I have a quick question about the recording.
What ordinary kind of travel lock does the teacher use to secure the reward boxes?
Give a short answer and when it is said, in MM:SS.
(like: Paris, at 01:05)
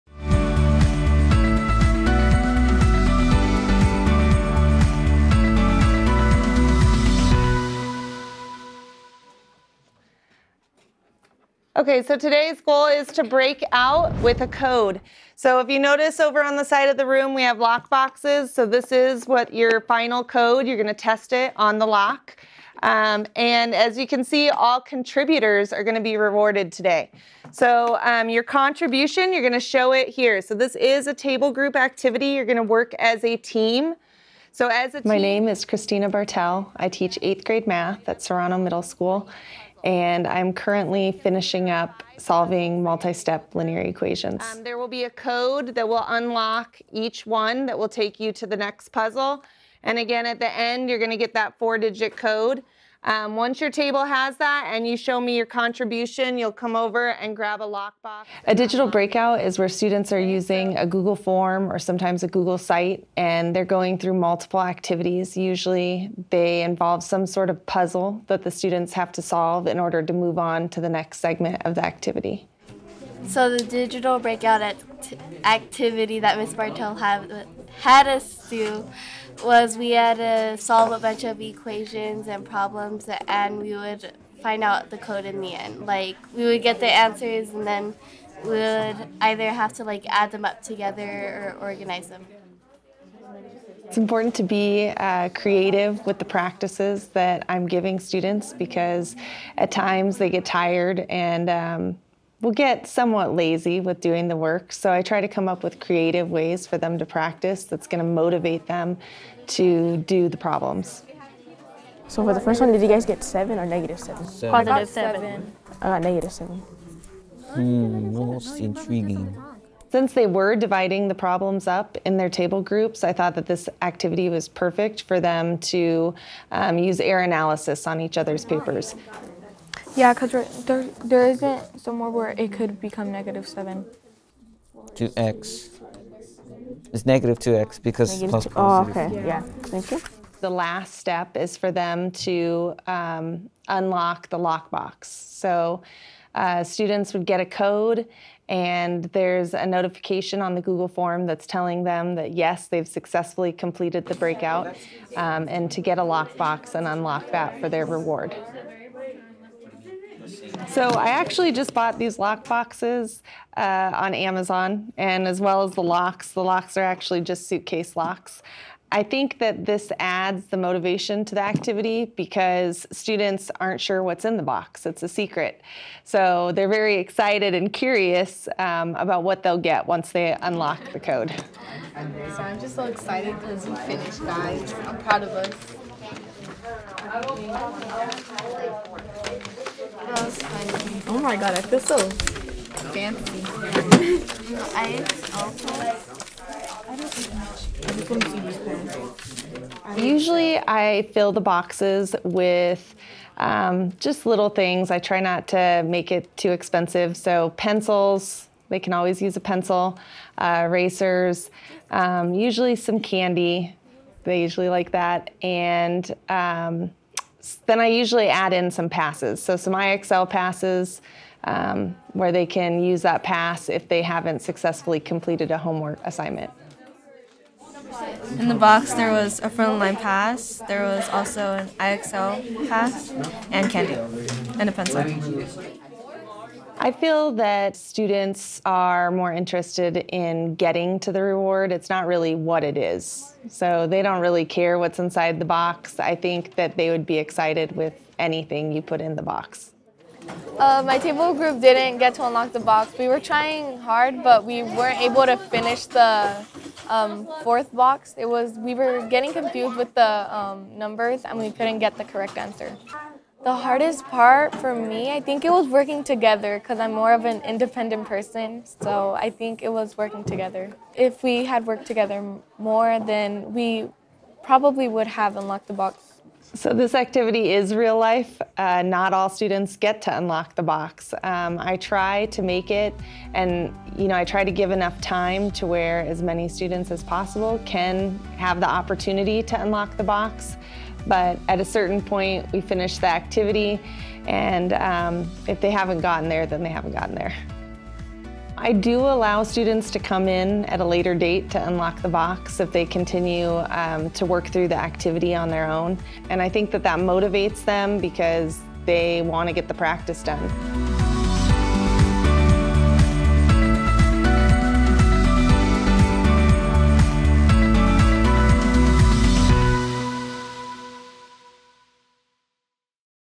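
Suitcase locks, at 02:47.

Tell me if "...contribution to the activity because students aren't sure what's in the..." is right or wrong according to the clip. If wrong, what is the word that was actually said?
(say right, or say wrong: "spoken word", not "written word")
wrong: "motivation", not "contribution".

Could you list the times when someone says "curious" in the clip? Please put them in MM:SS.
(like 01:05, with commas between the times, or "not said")
02:57.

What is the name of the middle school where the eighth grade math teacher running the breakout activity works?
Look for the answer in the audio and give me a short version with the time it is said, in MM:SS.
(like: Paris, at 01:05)
Serrano Middle School, at 00:38.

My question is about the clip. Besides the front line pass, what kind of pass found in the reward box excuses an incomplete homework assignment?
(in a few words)
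IXL pass.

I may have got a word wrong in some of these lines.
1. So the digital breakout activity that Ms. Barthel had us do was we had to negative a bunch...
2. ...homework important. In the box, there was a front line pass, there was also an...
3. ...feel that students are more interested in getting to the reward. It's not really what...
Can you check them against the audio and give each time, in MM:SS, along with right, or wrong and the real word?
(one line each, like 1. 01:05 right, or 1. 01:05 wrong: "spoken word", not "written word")
1. 01:13 wrong: "solve", not "negative"
2. 03:45 wrong: "assignment", not "important"
3. 03:56 right.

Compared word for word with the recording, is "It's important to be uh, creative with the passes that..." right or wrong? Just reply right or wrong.
wrong.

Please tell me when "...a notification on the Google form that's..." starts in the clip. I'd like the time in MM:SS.
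02:29.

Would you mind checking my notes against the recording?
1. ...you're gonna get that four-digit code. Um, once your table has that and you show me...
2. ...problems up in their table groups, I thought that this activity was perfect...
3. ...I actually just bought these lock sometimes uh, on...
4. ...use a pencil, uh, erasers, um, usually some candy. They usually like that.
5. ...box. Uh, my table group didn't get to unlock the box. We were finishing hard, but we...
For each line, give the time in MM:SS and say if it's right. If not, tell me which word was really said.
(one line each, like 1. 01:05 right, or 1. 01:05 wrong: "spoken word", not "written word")
1. 00:50 right
2. 02:01 right
3. 02:40 wrong: "boxes", not "sometimes"
4. 03:29 right
5. 04:09 wrong: "trying", not "finishing".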